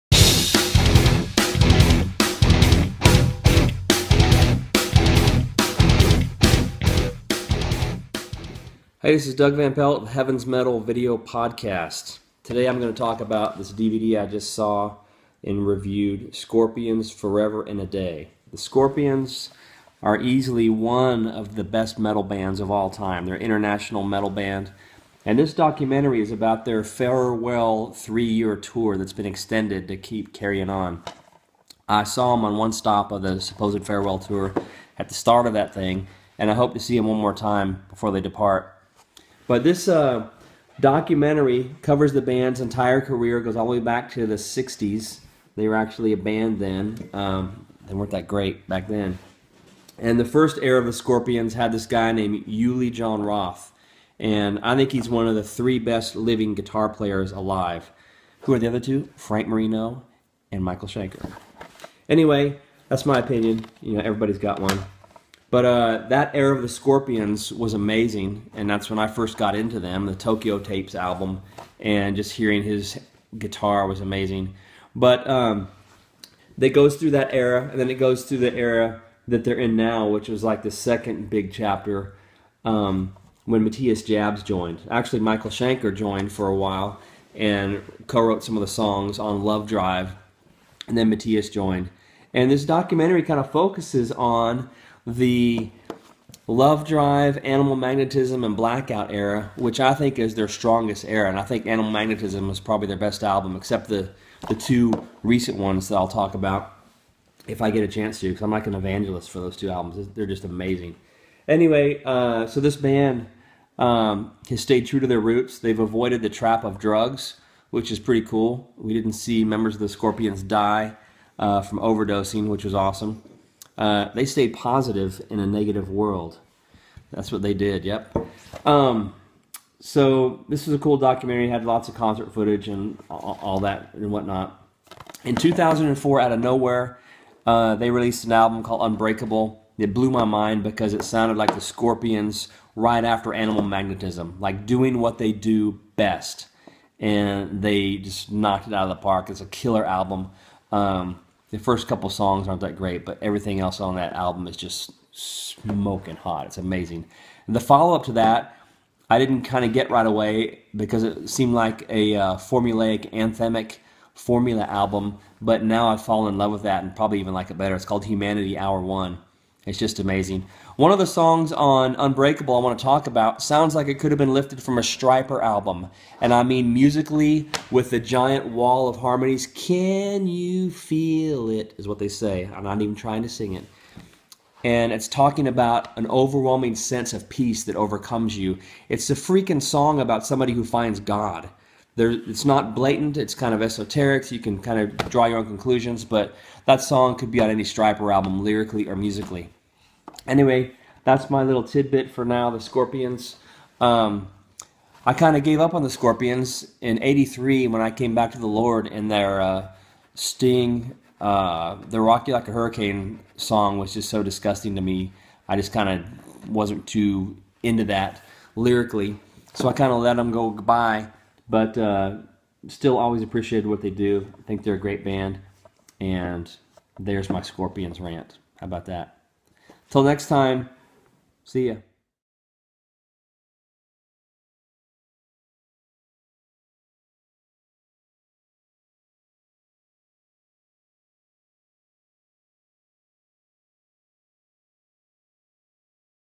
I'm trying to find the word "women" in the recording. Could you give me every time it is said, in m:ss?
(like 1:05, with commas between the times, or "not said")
not said.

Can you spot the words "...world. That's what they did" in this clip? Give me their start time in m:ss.
2:05.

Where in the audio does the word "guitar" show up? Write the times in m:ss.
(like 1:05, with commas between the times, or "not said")
0:56, 1:13.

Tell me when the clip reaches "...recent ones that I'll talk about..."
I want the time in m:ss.
1:45.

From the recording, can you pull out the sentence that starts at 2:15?
In 2004, out of nowhere, uh, they released an album called Unbreakable.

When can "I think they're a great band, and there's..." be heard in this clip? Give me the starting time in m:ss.
3:44.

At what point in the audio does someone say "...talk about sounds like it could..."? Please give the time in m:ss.
2:52.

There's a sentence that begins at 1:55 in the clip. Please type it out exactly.
They've avoided the trap of drugs, which is pretty cool.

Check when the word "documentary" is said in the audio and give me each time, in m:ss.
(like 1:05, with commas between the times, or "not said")
0:25, 0:40, 1:32, 2:10.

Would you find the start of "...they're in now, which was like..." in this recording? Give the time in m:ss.
1:19.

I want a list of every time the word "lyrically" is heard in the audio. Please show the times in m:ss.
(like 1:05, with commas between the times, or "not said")
3:18, 3:38.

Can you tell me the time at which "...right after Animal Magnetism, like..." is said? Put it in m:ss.
2:22.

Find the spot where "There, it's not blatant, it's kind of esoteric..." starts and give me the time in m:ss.
3:11.